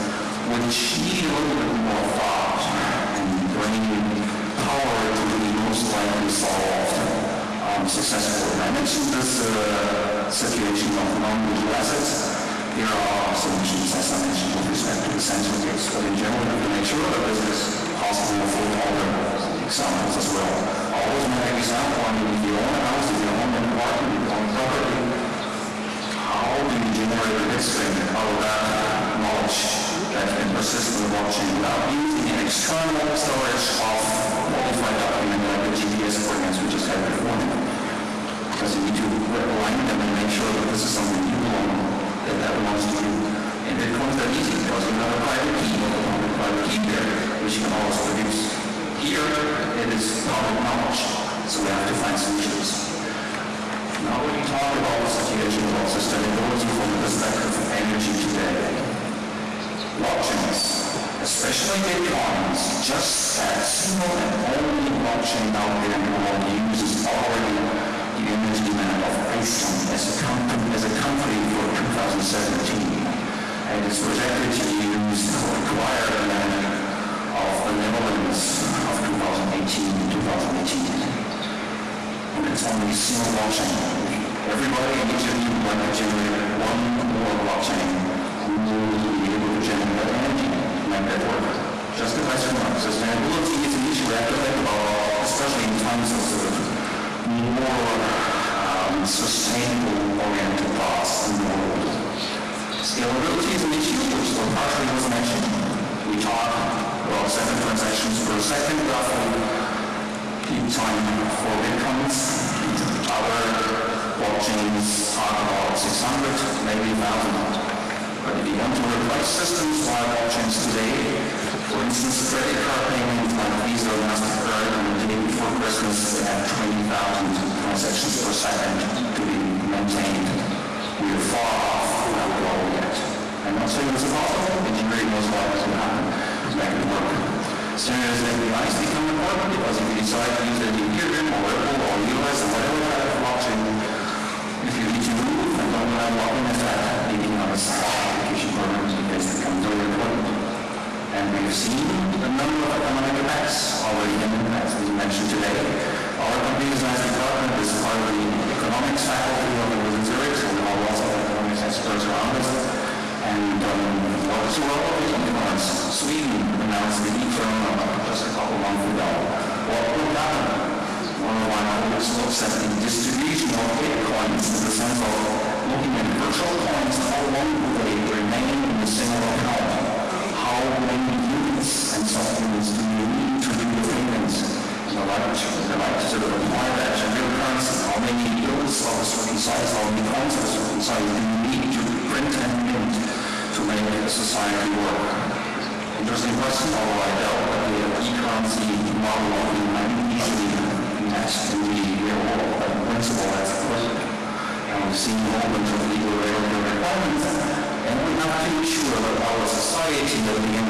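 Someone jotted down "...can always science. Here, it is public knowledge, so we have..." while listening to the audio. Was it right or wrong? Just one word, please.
wrong.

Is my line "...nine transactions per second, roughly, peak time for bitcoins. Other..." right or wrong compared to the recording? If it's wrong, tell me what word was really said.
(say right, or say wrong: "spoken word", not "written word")
wrong: "seven", not "nine".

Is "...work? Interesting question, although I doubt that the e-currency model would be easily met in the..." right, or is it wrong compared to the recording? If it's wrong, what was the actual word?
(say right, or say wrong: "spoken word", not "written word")
right.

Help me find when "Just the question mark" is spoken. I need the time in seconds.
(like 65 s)
91 s.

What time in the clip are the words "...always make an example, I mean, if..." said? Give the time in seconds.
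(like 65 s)
20 s.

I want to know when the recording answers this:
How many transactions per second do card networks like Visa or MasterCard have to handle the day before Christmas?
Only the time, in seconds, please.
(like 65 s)
126 s.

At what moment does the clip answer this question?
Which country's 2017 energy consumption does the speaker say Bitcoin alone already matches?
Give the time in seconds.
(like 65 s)
69 s.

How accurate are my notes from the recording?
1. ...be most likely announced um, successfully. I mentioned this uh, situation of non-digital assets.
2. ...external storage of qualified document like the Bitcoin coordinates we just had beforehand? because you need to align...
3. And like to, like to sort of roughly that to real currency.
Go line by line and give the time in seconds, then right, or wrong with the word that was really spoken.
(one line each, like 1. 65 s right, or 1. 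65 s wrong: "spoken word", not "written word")
1. 5 s wrong: "solved", not "announced"
2. 32 s wrong: "GPS", not "Bitcoin"
3. 184 s wrong: "apply", not "roughly".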